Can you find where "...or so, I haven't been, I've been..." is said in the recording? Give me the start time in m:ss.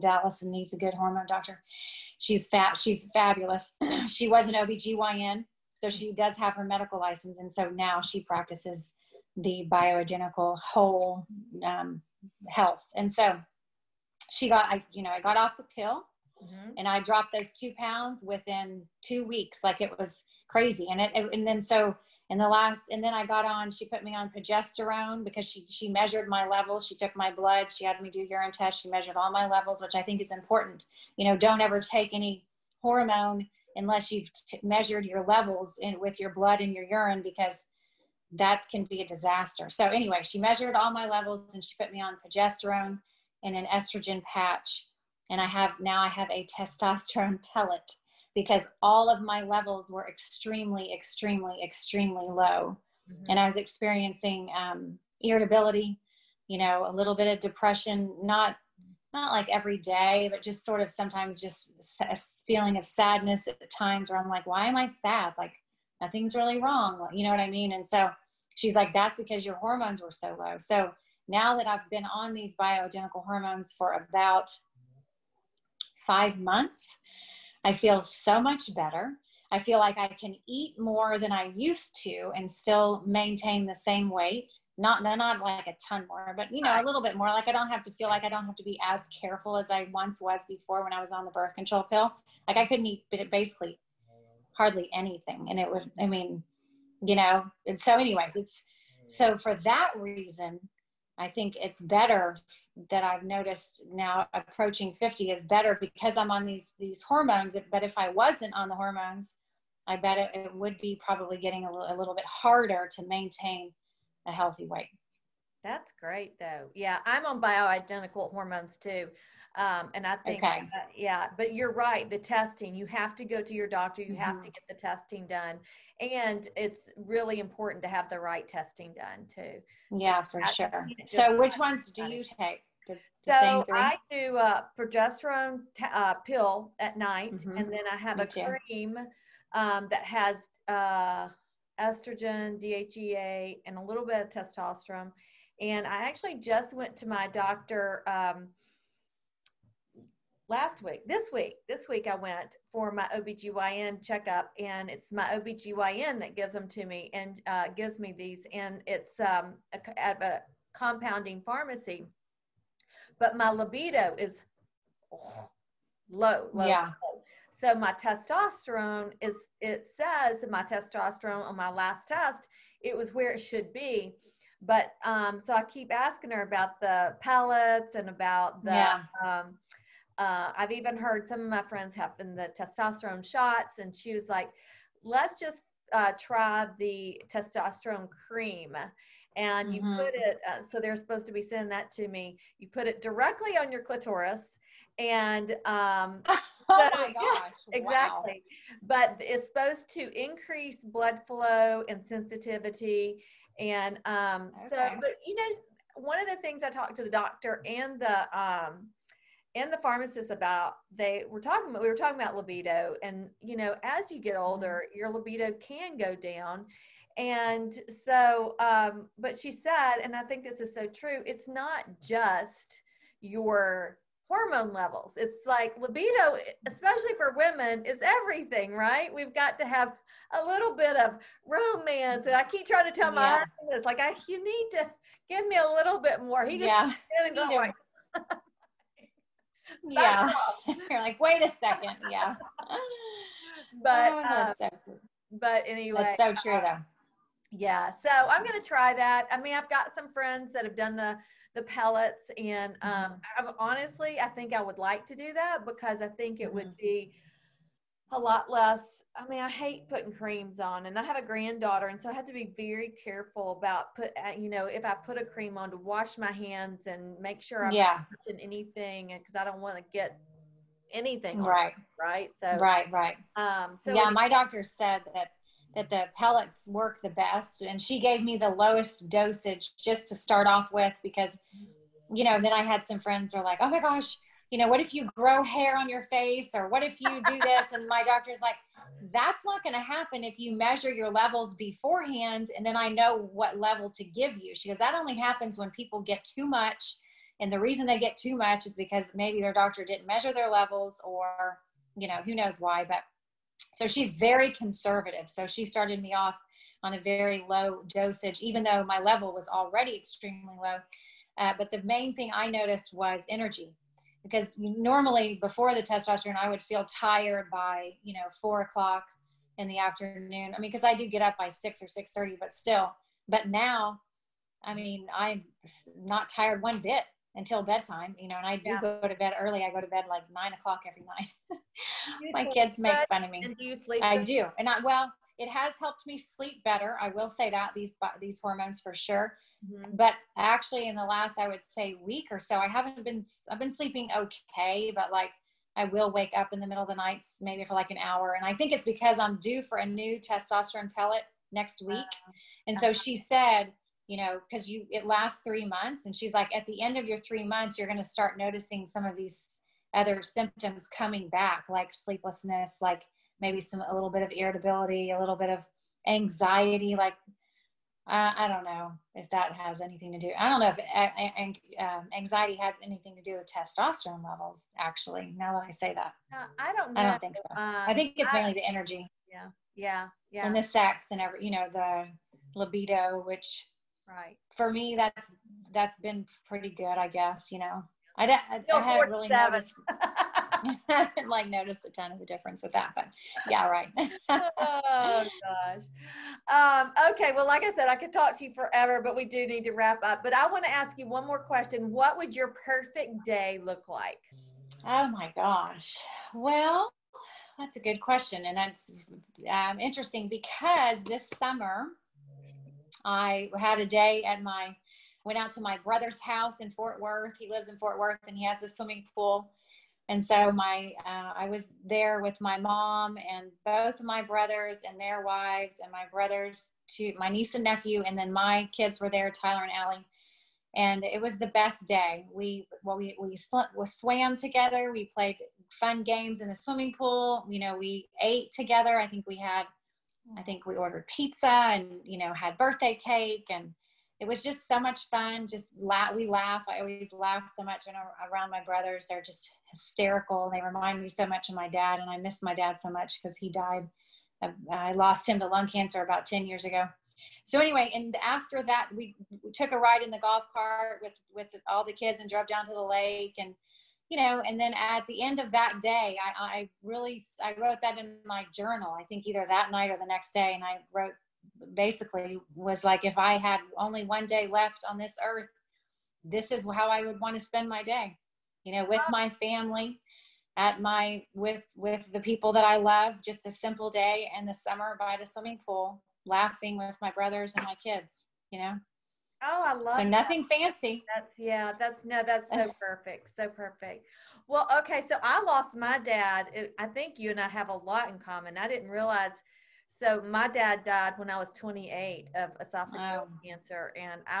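5:42.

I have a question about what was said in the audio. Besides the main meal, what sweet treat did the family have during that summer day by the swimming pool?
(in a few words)
Birthday cake.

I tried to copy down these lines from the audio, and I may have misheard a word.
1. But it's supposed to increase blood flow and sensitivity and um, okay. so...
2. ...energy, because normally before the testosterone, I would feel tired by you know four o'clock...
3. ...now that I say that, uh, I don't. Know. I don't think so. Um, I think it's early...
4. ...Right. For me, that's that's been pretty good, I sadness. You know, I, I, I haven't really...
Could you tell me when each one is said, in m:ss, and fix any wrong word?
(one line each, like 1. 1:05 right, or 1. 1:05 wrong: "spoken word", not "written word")
1. 3:18 right
2. 5:13 right
3. 6:15 wrong: "mainly", not "early"
4. 6:24 wrong: "guess", not "sadness".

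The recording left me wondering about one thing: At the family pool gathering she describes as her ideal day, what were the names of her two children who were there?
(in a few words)
Tyler and Allie.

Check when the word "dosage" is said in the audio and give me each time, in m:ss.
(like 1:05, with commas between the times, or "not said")
4:39, 5:07.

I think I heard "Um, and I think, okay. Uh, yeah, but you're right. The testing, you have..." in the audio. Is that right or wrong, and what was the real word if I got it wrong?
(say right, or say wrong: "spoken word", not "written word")
right.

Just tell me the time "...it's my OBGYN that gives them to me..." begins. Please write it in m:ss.
2:34.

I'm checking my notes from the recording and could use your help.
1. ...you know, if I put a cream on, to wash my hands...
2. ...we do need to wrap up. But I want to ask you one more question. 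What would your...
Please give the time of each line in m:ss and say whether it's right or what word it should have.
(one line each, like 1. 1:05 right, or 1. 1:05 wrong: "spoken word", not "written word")
1. 4:24 right
2. 6:39 right.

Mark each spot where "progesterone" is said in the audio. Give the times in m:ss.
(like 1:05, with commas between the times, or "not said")
0:24, 0:42, 2:14.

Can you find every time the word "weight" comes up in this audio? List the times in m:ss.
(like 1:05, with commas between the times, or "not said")
1:24, 1:54.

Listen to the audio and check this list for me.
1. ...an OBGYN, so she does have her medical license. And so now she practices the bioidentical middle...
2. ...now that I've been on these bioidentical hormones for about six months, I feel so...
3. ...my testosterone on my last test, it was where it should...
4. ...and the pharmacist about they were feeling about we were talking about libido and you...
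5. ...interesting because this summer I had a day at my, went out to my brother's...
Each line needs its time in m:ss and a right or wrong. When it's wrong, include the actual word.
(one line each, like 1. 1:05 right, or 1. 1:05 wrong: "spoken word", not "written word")
1. 0:04 wrong: "whole", not "middle"
2. 1:11 wrong: "five", not "six"
3. 2:50 right
4. 3:29 wrong: "talking", not "feeling"
5. 6:49 right.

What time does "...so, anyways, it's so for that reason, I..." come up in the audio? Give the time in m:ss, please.
1:37.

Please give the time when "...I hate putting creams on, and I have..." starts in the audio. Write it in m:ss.
4:19.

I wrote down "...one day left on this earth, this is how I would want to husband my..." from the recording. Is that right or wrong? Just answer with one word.
wrong.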